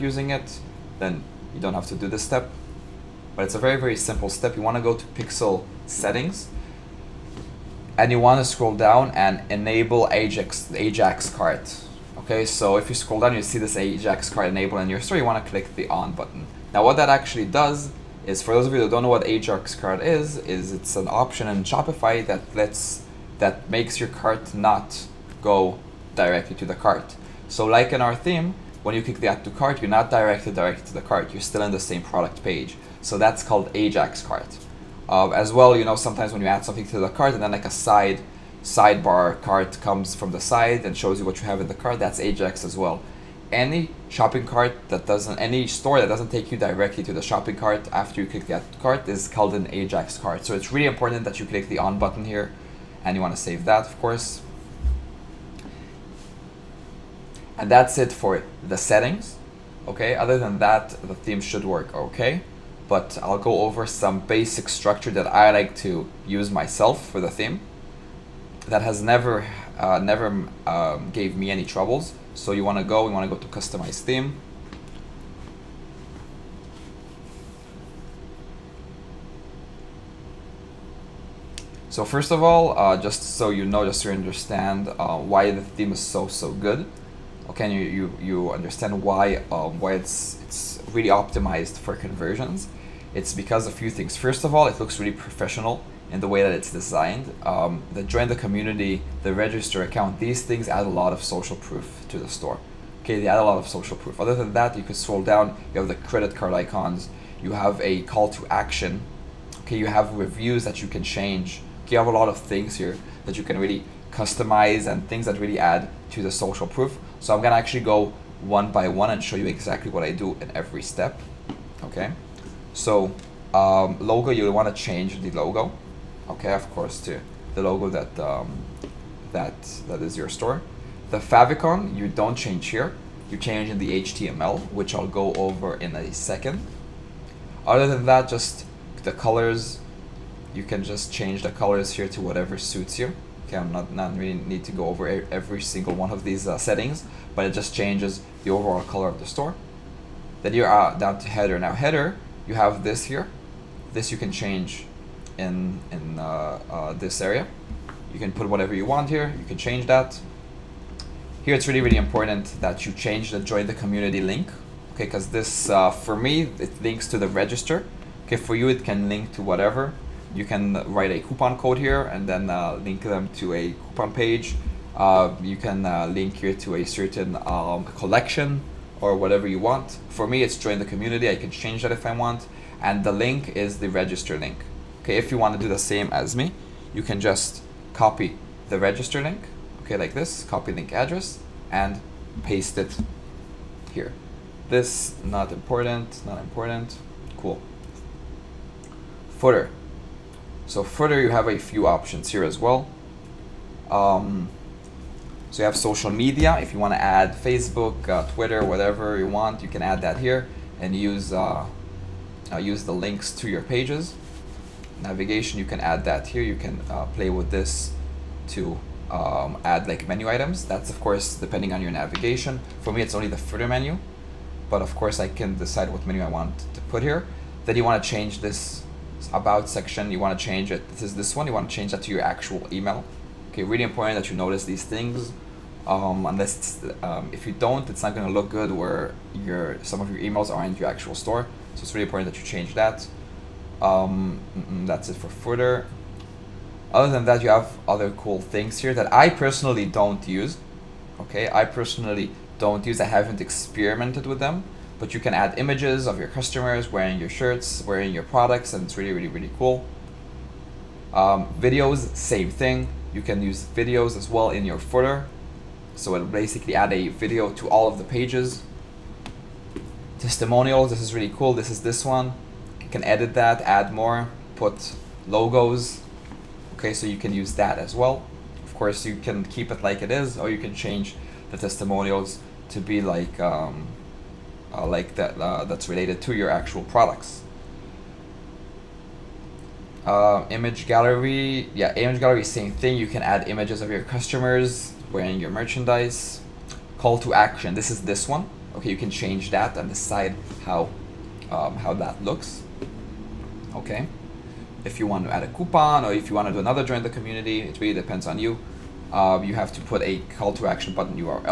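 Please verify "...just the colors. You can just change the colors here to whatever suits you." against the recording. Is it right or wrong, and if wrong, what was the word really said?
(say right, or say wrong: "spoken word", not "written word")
right.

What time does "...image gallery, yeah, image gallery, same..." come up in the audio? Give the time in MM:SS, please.
04:50.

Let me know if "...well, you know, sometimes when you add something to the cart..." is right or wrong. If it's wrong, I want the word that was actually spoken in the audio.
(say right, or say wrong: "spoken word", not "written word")
right.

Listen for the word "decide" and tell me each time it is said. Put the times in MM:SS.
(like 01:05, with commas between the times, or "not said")
03:45, 04:59.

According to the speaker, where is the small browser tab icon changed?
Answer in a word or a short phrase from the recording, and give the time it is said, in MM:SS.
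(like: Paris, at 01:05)
In the HTML, at 02:14.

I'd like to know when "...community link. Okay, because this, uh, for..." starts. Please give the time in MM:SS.
02:43.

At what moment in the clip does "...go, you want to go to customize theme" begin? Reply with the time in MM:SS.
01:12.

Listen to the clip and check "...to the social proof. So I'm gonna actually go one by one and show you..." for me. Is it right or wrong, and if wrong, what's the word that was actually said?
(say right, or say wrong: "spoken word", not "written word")
right.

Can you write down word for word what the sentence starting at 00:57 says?
And that's it for the settings.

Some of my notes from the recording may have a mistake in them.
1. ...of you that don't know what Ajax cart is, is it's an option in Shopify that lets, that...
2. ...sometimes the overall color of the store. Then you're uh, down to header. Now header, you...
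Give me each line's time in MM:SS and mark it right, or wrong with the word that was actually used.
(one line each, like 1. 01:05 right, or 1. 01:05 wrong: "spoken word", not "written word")
1. 00:18 right
2. 02:27 wrong: "changes", not "sometimes".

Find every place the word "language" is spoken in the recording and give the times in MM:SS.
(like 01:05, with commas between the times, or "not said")
not said.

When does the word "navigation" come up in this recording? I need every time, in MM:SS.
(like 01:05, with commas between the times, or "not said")
03:35, 03:41.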